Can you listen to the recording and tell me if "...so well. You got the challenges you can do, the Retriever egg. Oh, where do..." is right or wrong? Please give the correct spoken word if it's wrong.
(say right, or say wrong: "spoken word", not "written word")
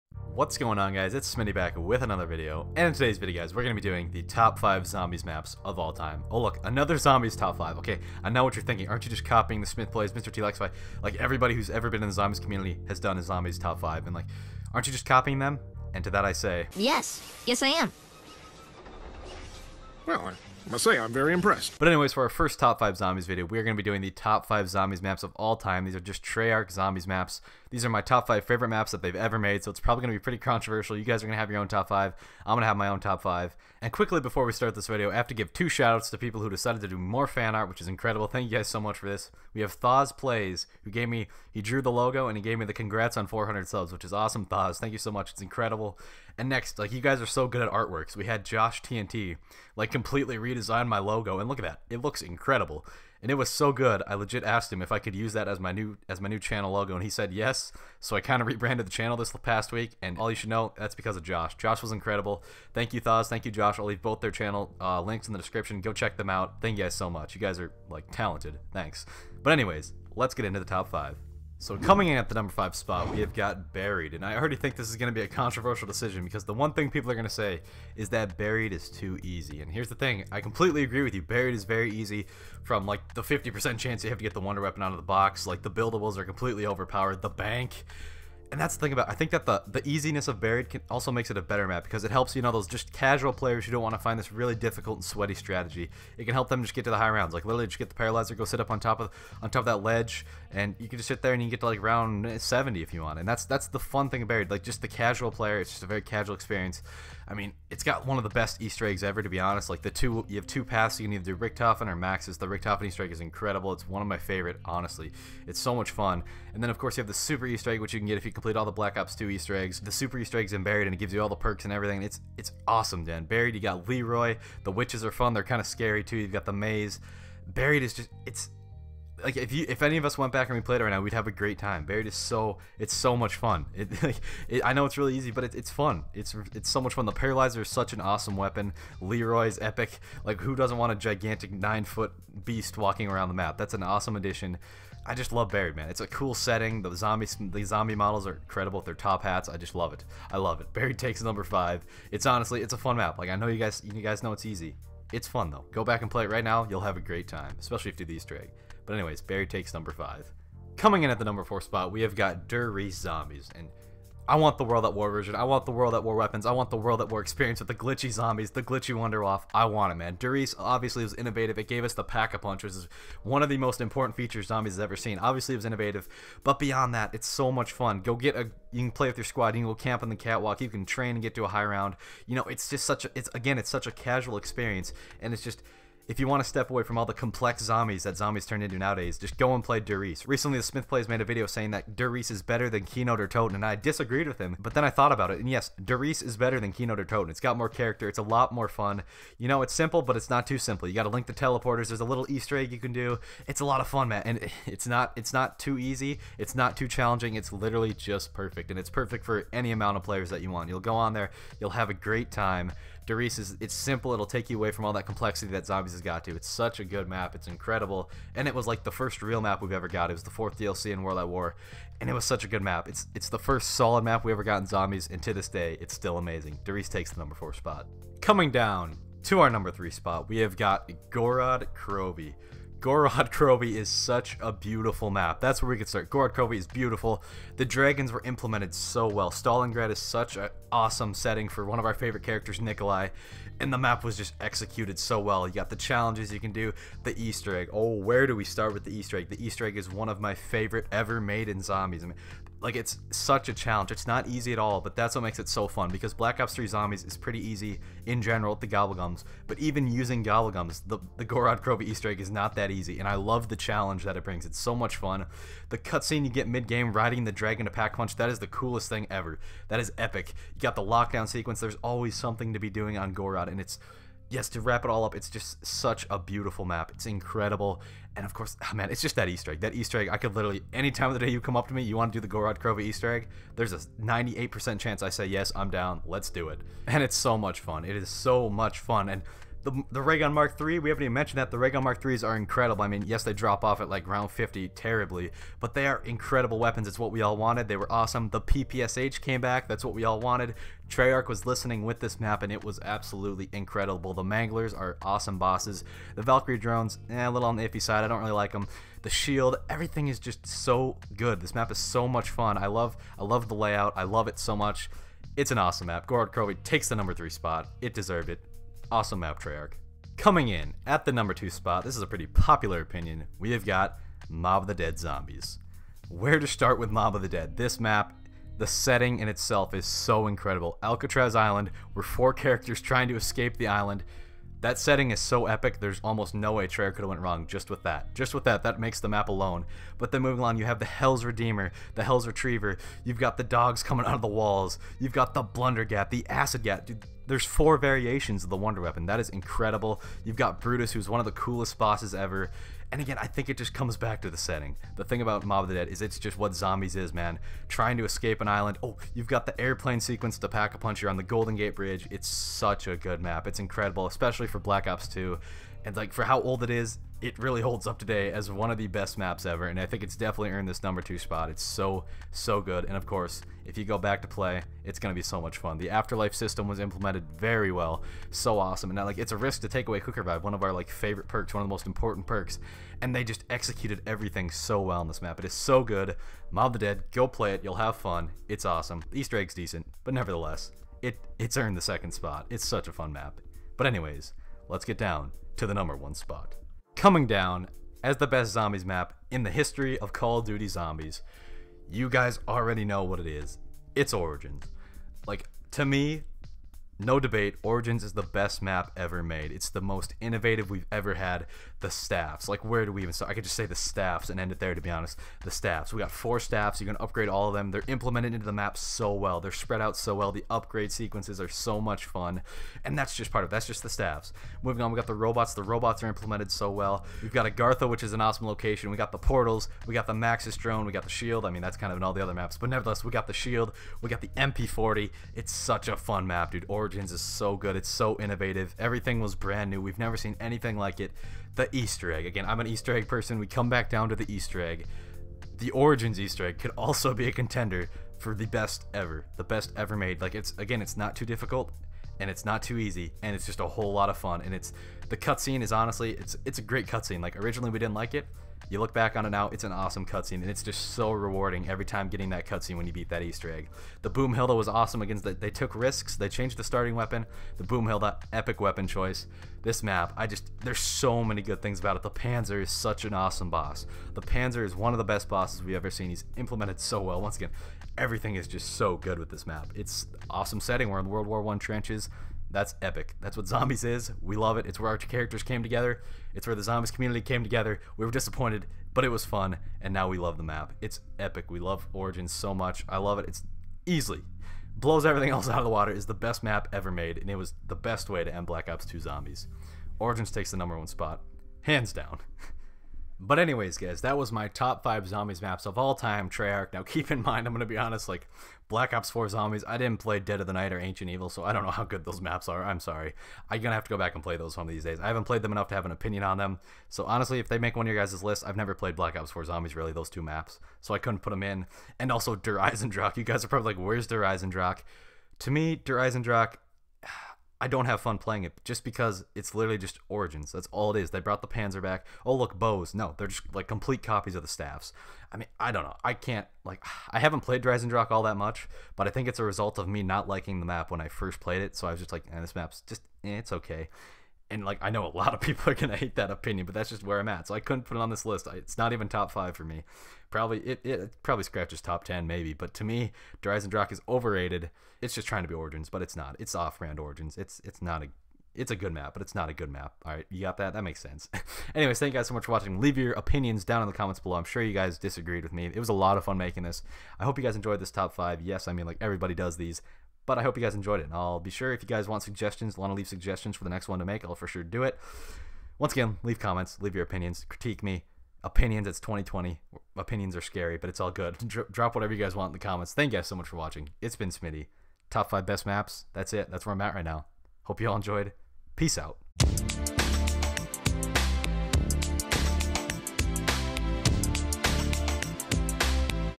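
wrong: "Easter", not "Retriever".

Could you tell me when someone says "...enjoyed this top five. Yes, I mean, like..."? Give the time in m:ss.
9:27.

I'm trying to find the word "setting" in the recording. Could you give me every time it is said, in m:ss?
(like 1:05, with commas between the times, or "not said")
2:26, 4:01, 5:28, 5:34, 5:54, 8:00.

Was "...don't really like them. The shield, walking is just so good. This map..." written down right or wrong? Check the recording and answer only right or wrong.
wrong.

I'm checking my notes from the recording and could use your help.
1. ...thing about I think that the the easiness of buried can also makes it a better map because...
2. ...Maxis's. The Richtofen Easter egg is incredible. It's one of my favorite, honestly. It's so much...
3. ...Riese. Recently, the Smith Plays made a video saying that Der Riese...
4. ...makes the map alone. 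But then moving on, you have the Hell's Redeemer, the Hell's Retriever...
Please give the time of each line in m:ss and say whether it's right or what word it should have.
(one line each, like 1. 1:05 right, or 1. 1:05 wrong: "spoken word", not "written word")
1. 1:28 right
2. 1:51 right
3. 3:09 right
4. 5:38 right.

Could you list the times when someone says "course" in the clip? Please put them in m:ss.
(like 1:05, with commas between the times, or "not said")
1:56, 4:38, 6:13.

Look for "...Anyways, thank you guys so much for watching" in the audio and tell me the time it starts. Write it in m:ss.
9:21.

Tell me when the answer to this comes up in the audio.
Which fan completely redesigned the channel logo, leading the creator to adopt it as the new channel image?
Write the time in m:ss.
0:48.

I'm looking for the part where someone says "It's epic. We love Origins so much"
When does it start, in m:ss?
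8:10.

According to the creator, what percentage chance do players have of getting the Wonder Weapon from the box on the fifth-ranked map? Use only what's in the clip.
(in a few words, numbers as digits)
50%.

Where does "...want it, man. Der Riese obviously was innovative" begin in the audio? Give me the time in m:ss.
2:49.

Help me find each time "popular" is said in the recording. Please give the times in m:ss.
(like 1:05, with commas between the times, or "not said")
5:22.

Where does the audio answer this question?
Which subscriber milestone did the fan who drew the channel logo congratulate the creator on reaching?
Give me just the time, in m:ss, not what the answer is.
0:43.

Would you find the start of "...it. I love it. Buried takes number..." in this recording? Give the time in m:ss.
2:29.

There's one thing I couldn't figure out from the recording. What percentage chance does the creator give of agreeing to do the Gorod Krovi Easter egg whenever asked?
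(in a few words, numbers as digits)
98%.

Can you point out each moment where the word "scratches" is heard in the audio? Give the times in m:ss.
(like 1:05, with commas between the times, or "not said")
9:11.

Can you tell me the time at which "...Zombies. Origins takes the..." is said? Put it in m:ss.
8:18.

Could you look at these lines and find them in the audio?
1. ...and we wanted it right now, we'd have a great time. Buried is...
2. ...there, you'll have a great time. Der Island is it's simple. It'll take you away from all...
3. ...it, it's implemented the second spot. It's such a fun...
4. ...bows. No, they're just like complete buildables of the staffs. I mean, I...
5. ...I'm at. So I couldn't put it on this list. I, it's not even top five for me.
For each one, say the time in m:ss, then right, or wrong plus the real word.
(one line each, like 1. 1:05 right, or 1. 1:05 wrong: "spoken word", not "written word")
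1. 2:10 wrong: "played", not "wanted"
2. 3:31 wrong: "Riese", not "Island"
3. 6:31 wrong: "earned", not "implemented"
4. 8:52 wrong: "copies", not "buildables"
5. 9:07 right.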